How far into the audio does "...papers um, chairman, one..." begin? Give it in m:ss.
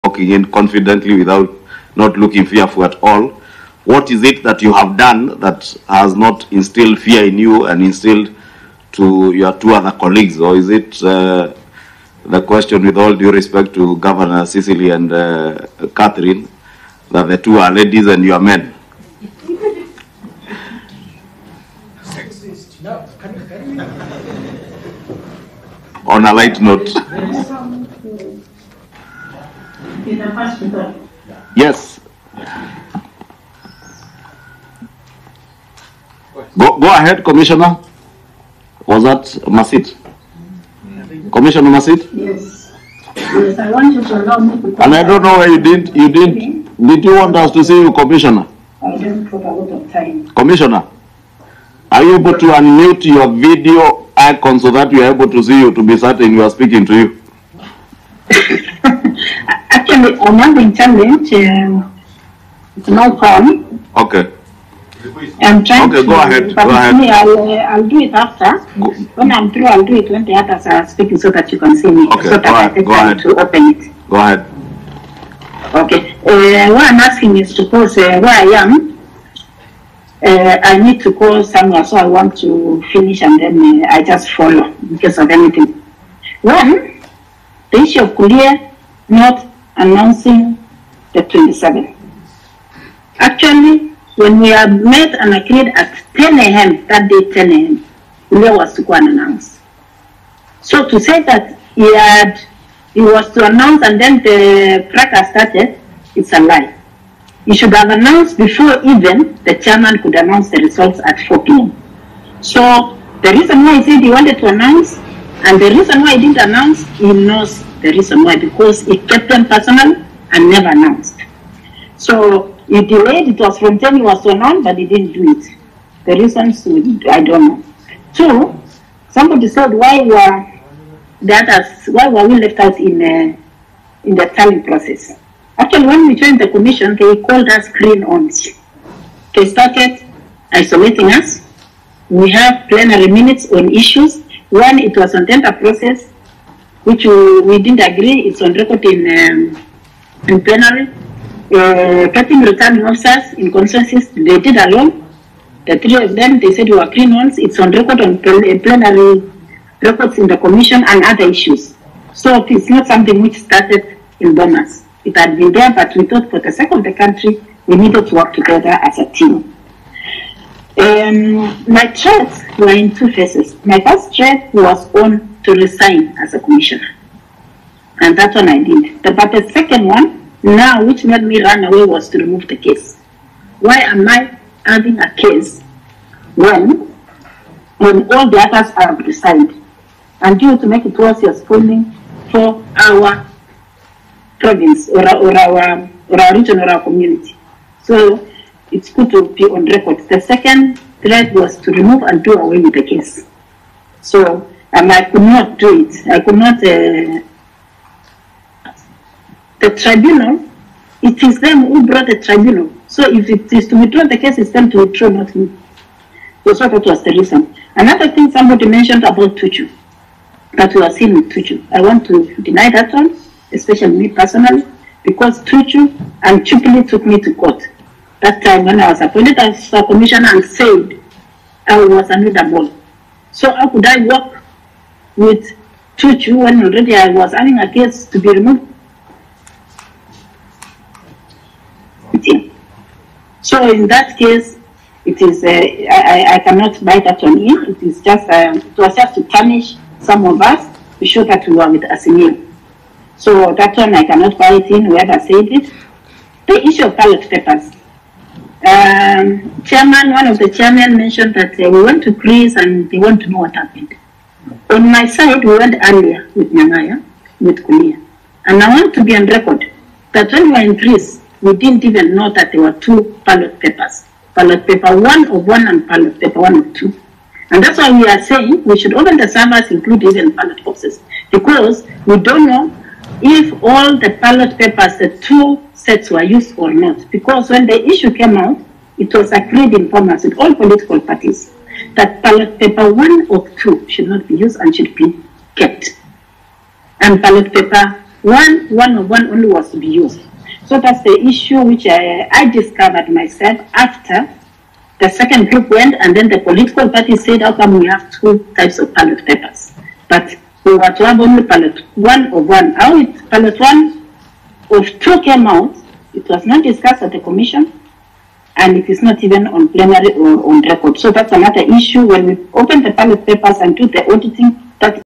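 4:17.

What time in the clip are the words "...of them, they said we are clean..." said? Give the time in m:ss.
2:36.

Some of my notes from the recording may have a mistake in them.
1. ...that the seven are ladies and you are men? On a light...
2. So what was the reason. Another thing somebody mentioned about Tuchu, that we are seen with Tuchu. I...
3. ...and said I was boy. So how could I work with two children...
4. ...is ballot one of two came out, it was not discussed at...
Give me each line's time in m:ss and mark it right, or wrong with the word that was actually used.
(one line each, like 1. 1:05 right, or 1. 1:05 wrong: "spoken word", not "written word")
1. 0:17 wrong: "two", not "seven"
2. 3:36 right
3. 3:50 right
4. 5:12 right.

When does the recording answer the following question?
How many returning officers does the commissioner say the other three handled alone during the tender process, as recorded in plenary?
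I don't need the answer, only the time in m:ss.
2:32.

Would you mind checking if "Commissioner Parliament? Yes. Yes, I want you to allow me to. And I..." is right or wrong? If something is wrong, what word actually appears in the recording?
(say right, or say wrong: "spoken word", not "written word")
wrong: "Masit", not "Parliament".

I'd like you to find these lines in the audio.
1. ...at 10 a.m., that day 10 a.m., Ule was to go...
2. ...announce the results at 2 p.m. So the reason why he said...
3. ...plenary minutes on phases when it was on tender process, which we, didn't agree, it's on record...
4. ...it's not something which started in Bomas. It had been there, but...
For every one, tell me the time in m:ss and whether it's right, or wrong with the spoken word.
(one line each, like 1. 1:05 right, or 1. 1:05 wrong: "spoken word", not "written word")
1. 1:35 right
2. 1:50 wrong: "4", not "2"
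3. 2:22 wrong: "issues", not "phases"
4. 2:42 right.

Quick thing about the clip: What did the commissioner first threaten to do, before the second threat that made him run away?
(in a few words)
resign as a commissioner.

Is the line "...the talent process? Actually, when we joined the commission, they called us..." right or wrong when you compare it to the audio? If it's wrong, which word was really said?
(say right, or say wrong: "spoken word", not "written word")
right.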